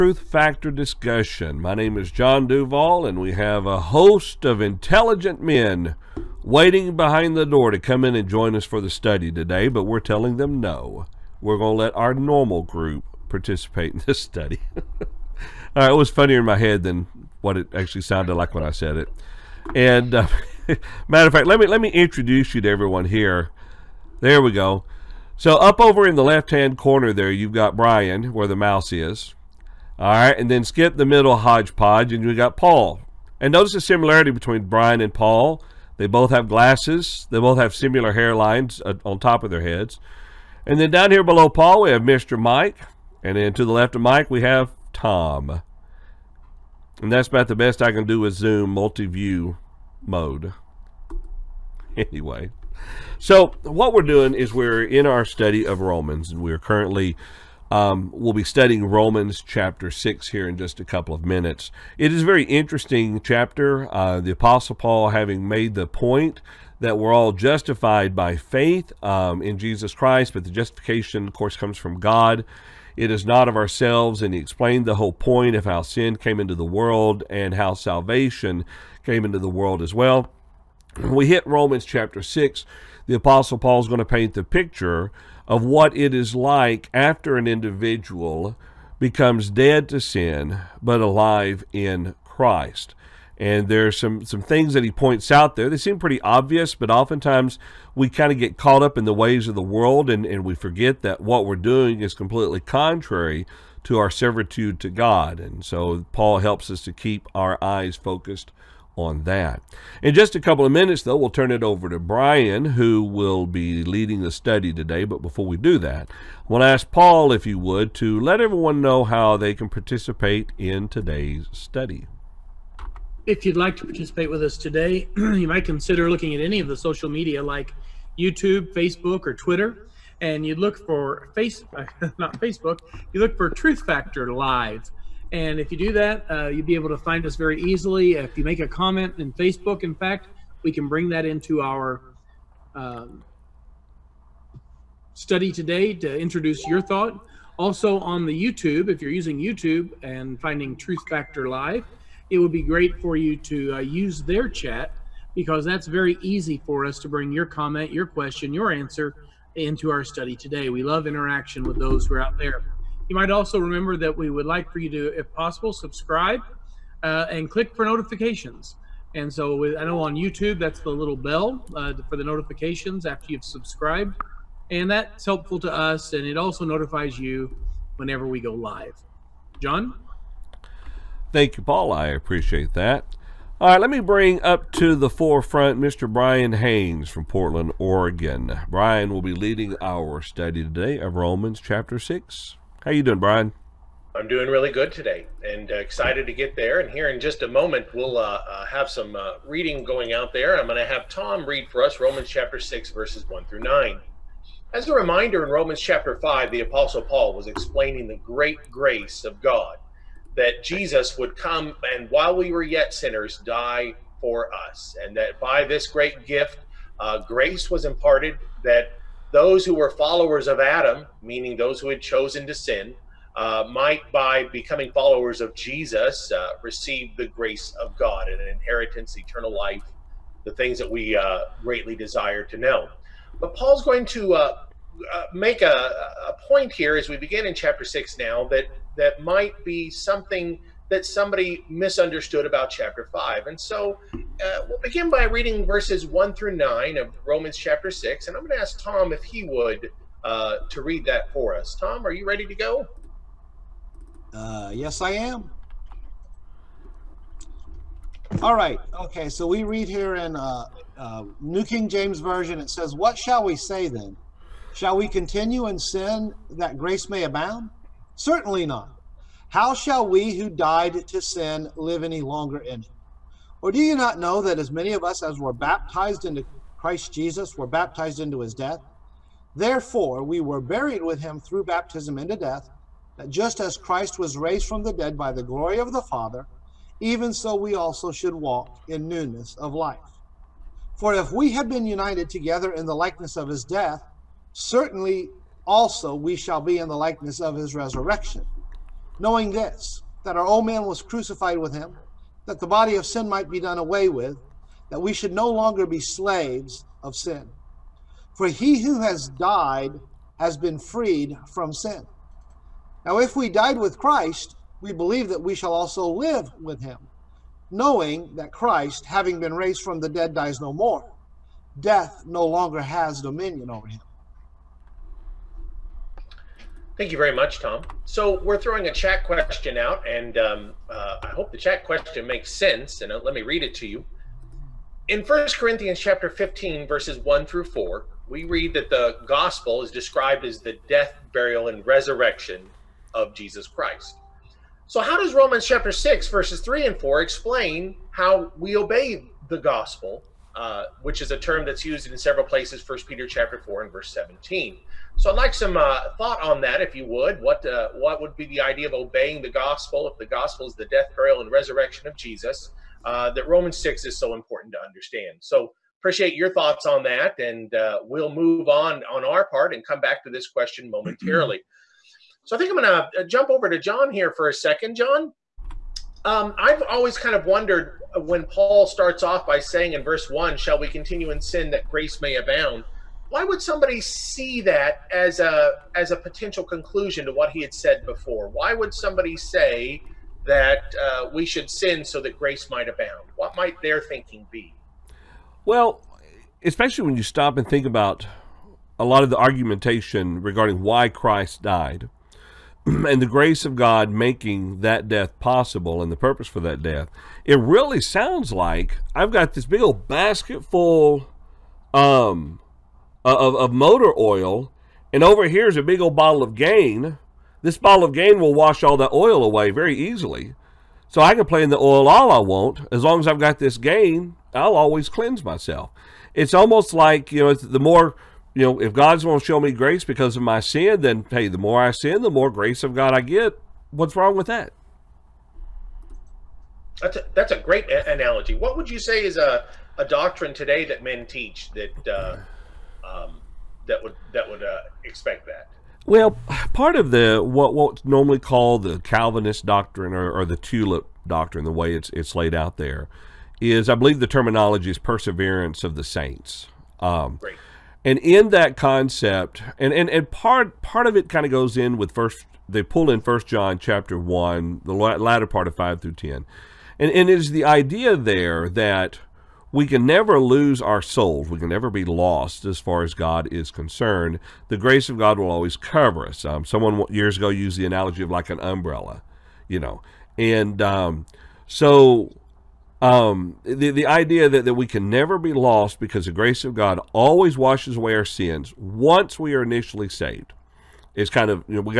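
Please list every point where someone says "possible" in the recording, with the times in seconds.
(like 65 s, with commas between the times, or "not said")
165 s, 405 s.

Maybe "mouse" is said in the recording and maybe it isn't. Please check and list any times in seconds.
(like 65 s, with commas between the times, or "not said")
28 s.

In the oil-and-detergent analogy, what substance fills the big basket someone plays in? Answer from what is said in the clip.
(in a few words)
motor oil.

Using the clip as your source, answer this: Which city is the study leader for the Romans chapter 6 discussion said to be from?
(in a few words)
Portland, Oregon.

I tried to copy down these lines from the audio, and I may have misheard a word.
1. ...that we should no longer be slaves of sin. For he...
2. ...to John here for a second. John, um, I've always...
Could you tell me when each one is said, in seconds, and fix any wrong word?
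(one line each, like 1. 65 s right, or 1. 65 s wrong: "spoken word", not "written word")
1. 304 s right
2. 373 s right.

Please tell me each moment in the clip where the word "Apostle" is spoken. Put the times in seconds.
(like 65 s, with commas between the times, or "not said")
64 s, 83 s, 206 s.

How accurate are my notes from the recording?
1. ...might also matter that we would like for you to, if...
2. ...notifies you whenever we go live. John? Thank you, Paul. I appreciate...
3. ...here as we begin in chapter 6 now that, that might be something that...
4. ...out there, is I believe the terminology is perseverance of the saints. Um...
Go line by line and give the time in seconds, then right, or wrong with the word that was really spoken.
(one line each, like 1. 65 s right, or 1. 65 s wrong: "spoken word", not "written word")
1. 163 s wrong: "remember", not "matter"
2. 176 s right
3. 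236 s right
4. 452 s right.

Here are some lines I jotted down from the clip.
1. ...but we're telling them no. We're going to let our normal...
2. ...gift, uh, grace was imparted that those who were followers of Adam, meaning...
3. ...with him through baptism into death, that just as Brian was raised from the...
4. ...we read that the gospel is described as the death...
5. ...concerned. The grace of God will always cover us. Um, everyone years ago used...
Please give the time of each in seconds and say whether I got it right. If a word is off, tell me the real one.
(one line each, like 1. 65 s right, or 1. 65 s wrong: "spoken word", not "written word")
1. 9 s right
2. 216 s right
3. 281 s wrong: "Christ", not "Brian"
4. 338 s right
5. 473 s wrong: "someone", not "everyone".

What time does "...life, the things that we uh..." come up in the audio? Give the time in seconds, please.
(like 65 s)
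229 s.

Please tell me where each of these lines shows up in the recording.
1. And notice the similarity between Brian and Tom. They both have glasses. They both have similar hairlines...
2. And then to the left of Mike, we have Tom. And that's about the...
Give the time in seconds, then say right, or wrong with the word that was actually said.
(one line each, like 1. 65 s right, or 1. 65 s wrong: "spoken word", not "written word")
1. 33 s wrong: "Paul", not "Tom"
2. 43 s right.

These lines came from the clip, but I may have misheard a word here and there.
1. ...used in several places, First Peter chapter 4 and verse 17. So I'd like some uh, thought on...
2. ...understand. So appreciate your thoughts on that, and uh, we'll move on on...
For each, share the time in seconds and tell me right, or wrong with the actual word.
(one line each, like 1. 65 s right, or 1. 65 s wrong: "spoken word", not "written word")
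1. 351 s right
2. 364 s right.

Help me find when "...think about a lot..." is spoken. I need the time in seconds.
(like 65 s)
397 s.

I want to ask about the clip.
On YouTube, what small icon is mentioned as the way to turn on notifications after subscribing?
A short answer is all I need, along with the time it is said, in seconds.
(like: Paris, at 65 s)
the little bell, at 170 s.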